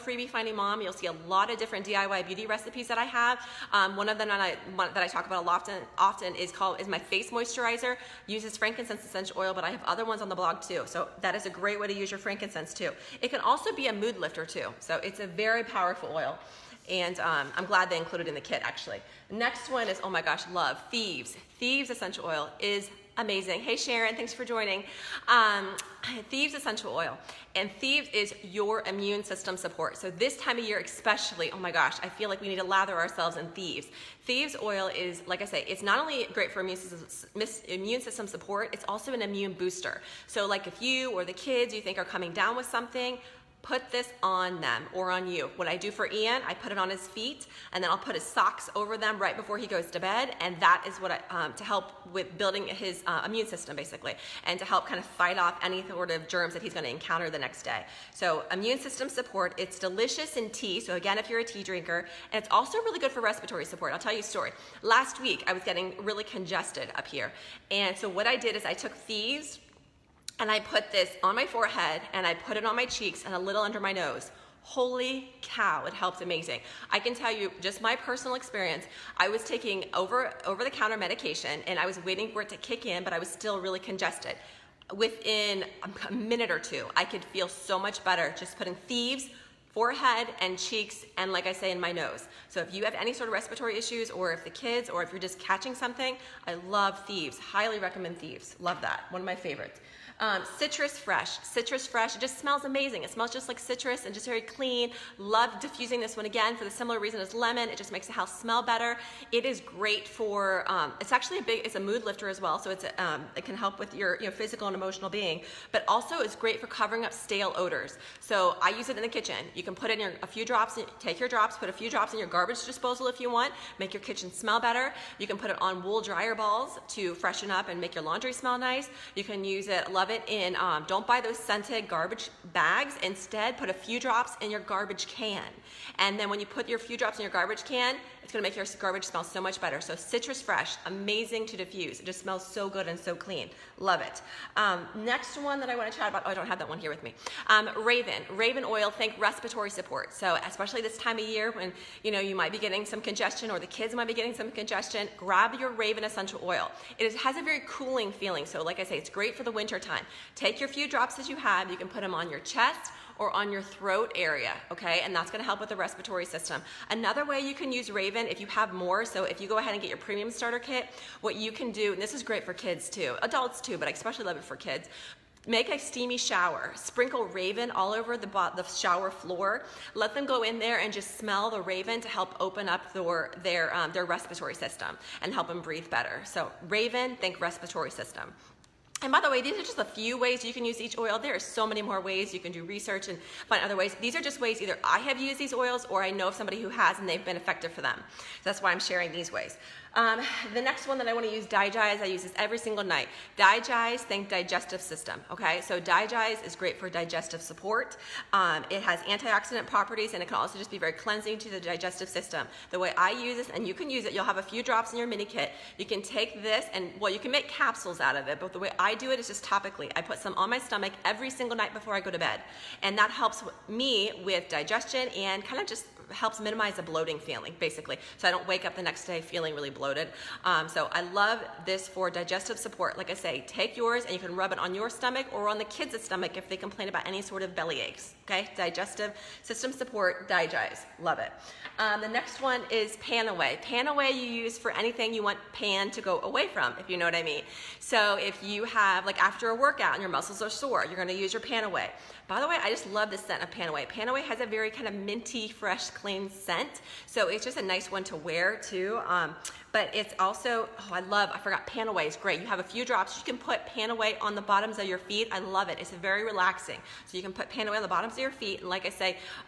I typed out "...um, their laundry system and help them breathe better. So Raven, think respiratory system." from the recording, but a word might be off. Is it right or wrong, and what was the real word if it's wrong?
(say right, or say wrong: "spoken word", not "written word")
wrong: "respiratory", not "laundry".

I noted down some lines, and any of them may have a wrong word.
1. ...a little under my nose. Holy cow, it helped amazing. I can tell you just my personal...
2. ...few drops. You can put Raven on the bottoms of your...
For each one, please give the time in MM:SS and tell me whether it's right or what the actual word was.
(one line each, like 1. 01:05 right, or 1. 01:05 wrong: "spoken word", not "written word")
1. 01:13 right
2. 04:22 wrong: "PanAway", not "Raven".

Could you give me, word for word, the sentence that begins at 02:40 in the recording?
Take your few drops that you have, you can put them on your chest or on your throat area, okay?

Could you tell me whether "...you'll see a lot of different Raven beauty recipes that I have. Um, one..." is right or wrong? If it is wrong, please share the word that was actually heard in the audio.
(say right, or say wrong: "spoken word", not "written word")
wrong: "DIY", not "Raven".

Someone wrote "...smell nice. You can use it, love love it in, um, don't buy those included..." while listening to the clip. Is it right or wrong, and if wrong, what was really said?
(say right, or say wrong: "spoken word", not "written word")
wrong: "scented", not "included".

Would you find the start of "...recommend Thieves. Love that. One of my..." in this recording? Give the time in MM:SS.
01:37.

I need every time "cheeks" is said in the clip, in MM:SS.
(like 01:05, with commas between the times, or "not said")
01:12, 01:30.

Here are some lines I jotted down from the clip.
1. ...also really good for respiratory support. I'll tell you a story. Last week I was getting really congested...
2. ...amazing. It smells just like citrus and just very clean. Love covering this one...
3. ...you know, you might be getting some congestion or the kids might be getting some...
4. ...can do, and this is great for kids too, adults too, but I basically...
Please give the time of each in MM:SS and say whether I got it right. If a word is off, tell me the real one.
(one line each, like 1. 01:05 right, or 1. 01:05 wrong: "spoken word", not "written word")
1. 01:02 right
2. 01:42 wrong: "diffusing", not "covering"
3. 02:32 right
4. 02:51 wrong: "especially", not "basically".